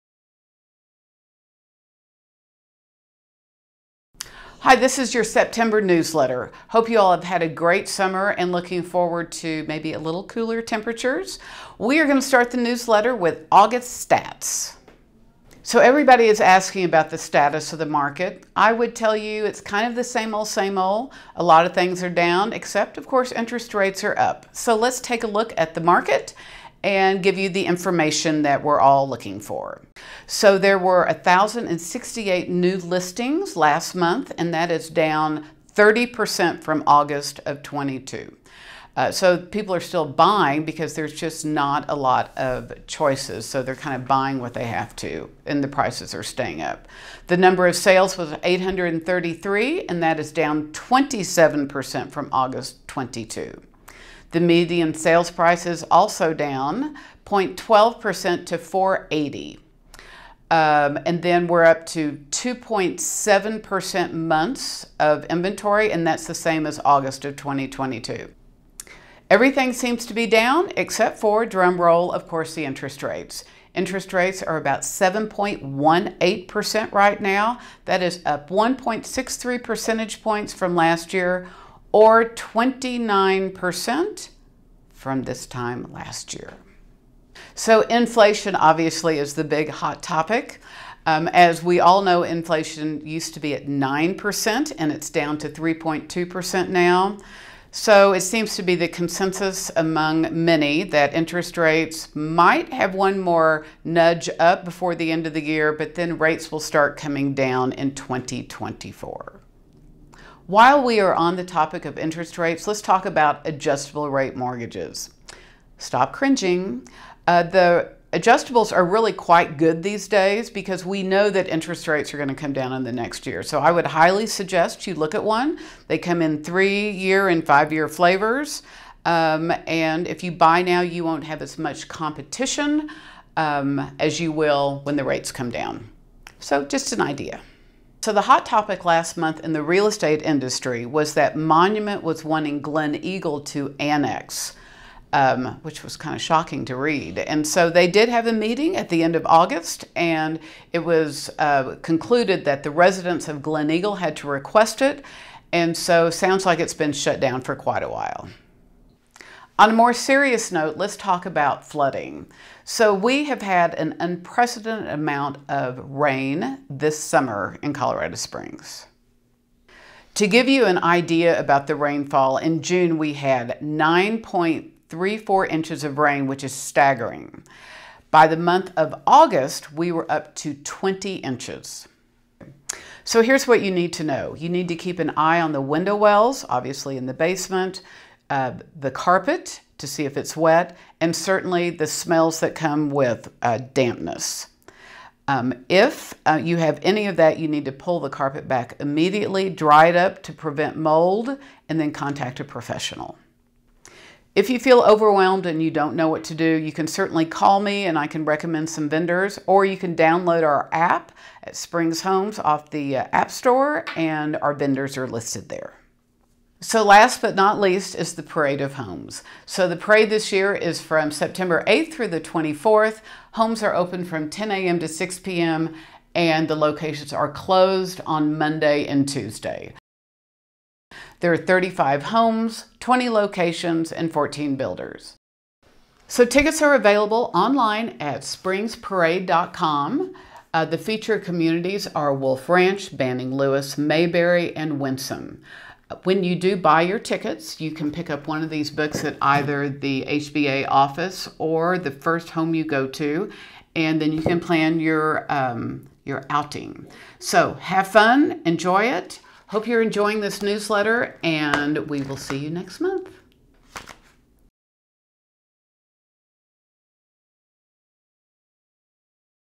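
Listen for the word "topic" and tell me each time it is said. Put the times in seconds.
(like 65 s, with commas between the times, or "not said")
90 s, 111 s, 138 s.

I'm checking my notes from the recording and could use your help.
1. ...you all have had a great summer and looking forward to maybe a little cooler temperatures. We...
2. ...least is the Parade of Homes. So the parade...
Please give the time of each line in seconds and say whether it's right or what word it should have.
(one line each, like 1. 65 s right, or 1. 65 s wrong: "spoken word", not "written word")
1. 6 s right
2. 217 s right.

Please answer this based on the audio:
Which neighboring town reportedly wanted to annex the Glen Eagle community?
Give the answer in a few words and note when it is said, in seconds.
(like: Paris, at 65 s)
Monument, at 141 s.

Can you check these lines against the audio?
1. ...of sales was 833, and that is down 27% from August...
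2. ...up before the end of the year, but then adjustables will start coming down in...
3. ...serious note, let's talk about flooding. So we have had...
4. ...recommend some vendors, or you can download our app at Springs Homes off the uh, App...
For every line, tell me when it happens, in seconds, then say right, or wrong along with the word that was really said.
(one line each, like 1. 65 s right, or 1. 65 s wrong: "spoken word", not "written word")
1. 47 s right
2. 104 s wrong: "rates", not "adjustables"
3. 159 s right
4. 208 s right.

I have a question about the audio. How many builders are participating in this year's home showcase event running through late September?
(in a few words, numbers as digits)
14.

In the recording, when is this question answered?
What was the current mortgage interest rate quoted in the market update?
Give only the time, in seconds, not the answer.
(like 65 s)
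74 s.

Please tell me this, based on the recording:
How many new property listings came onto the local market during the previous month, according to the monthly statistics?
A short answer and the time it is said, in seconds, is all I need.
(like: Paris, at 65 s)
1,068, at 31 s.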